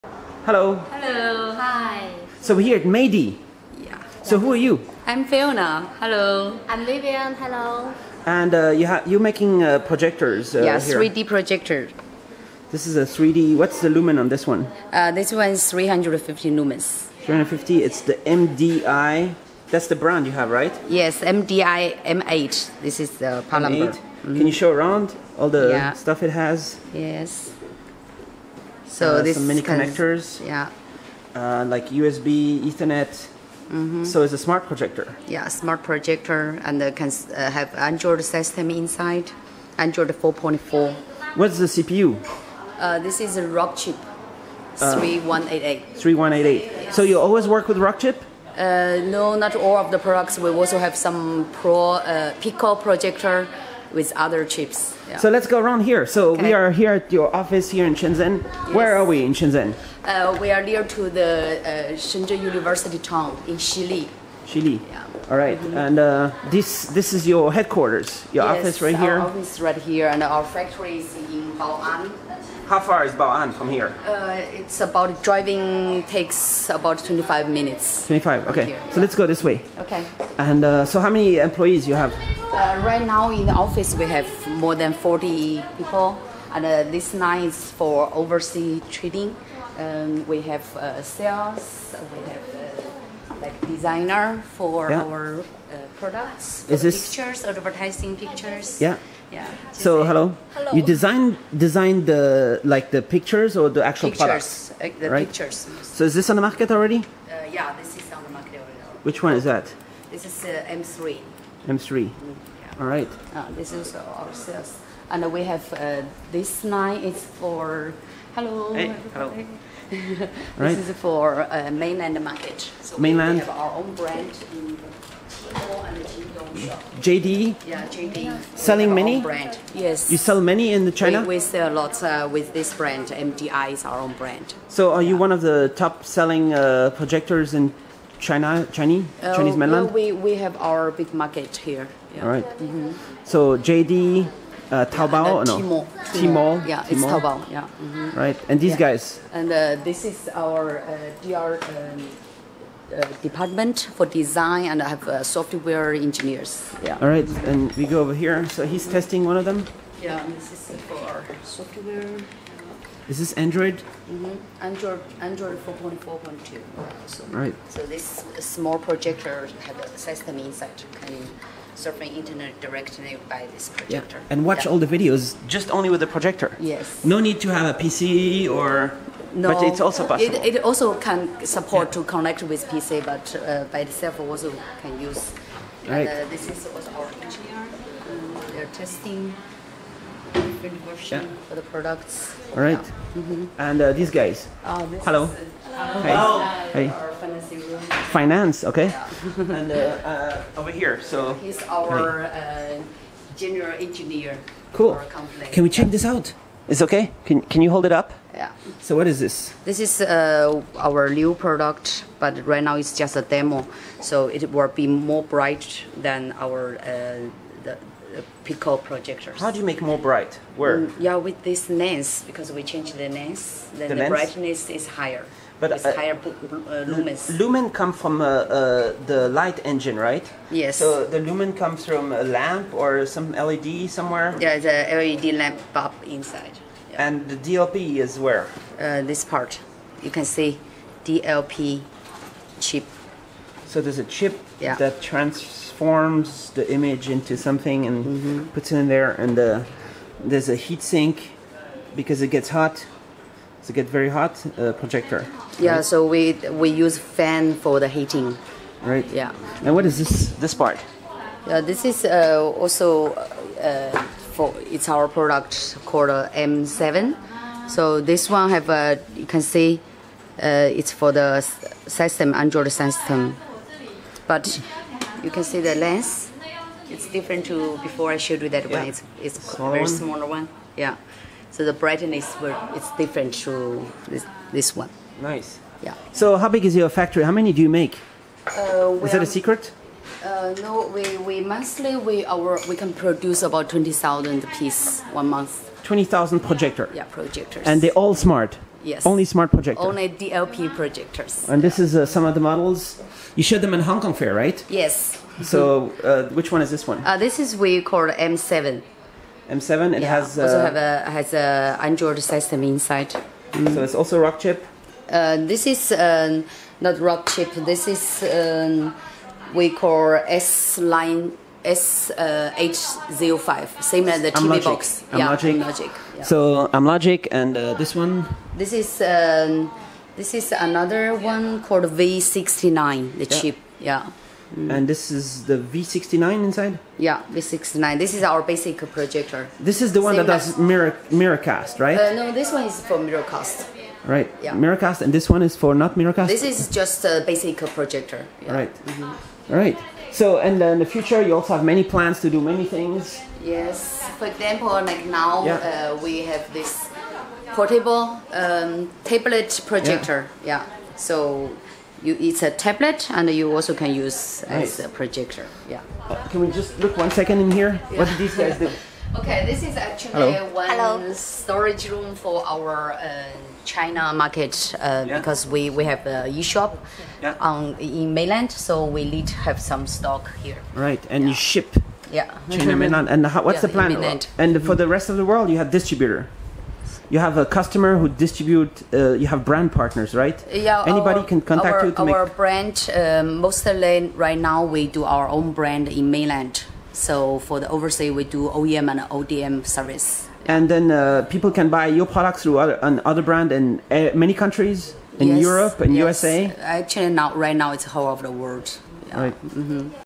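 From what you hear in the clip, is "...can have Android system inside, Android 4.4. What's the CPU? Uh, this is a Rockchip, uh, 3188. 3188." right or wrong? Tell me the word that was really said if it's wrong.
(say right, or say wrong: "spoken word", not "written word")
right.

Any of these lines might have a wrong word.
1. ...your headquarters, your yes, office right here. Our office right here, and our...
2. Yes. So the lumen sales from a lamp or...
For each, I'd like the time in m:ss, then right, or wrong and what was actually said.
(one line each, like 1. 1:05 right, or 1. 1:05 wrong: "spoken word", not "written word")
1. 1:07 right
2. 3:50 wrong: "comes", not "sales".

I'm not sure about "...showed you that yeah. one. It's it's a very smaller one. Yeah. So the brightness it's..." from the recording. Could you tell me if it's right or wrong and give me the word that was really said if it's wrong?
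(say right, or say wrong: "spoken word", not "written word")
right.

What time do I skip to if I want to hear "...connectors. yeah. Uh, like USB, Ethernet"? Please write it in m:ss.
0:29.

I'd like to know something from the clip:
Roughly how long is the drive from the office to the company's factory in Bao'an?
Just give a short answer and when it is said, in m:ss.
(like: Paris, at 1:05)
25 minutes, at 1:16.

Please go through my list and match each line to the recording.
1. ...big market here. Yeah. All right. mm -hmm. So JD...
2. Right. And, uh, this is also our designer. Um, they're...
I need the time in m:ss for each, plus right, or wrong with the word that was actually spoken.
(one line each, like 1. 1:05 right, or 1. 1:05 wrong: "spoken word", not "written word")
1. 2:20 right
2. 3:05 wrong: "engineer", not "designer".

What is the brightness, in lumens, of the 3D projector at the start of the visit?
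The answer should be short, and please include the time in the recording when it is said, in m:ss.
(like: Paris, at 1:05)
350 lumens, at 0:15.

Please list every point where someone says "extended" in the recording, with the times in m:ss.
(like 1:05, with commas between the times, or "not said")
not said.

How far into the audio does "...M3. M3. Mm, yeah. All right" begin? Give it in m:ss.
1:50.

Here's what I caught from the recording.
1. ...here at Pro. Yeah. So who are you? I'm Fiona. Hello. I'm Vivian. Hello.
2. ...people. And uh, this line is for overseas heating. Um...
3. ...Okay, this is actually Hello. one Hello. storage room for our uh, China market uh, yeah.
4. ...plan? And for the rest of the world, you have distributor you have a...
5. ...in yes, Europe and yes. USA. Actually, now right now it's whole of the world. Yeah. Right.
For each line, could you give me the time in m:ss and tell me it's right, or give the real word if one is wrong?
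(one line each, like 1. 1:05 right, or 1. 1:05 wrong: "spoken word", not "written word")
1. 0:02 wrong: "Meidi", not "Pro"
2. 1:25 wrong: "trading", not "heating"
3. 6:09 right
4. 6:23 right
5. 6:45 right.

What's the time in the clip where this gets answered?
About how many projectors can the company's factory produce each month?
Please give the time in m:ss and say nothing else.
4:53.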